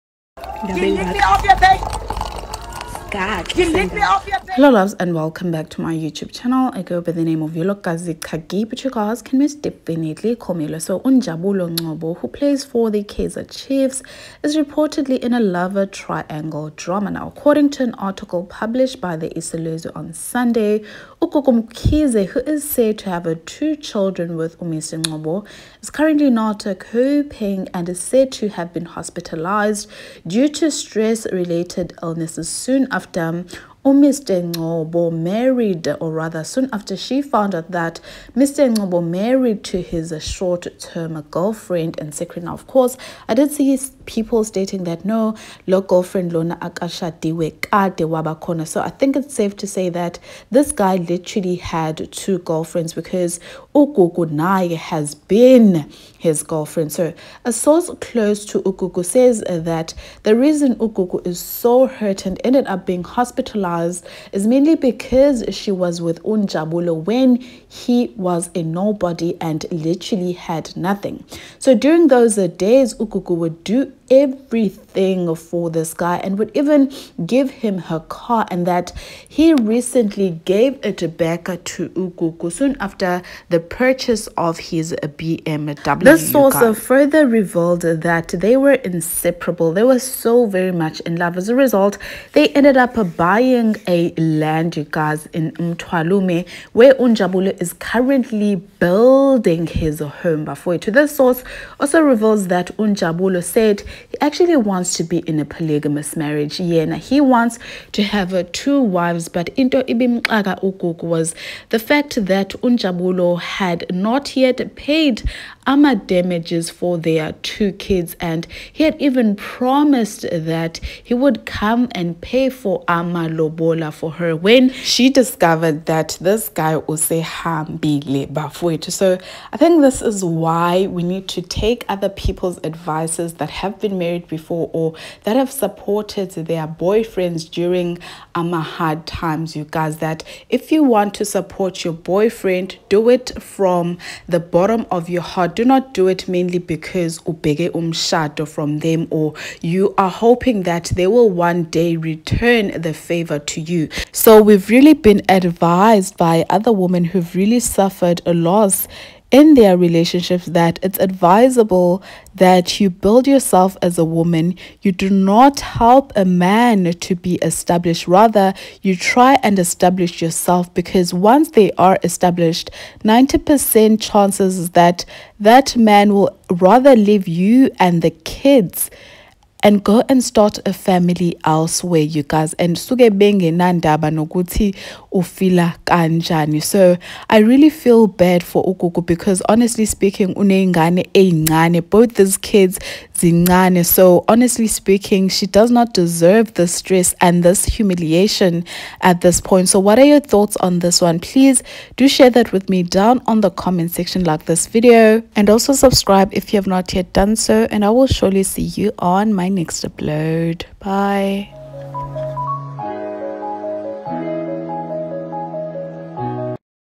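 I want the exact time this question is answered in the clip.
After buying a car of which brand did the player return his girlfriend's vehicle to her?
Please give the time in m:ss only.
1:25.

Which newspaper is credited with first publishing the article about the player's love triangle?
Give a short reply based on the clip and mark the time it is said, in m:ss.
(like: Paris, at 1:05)
Isolezwe, at 0:19.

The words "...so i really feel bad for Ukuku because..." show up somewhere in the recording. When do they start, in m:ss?
3:06.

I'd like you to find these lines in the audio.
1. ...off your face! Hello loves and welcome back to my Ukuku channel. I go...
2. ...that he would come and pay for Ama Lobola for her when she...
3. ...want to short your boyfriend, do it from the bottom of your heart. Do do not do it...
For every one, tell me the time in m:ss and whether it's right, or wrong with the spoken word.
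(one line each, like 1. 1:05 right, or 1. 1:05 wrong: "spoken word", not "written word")
1. 0:01 wrong: "YouTube", not "Ukuku"
2. 2:00 right
3. 2:20 wrong: "support", not "short".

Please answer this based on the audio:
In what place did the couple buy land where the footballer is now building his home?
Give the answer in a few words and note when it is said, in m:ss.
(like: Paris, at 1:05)
Mtwalume, at 1:35.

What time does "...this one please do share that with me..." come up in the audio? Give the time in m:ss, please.
3:20.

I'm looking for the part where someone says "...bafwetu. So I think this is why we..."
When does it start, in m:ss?
2:08.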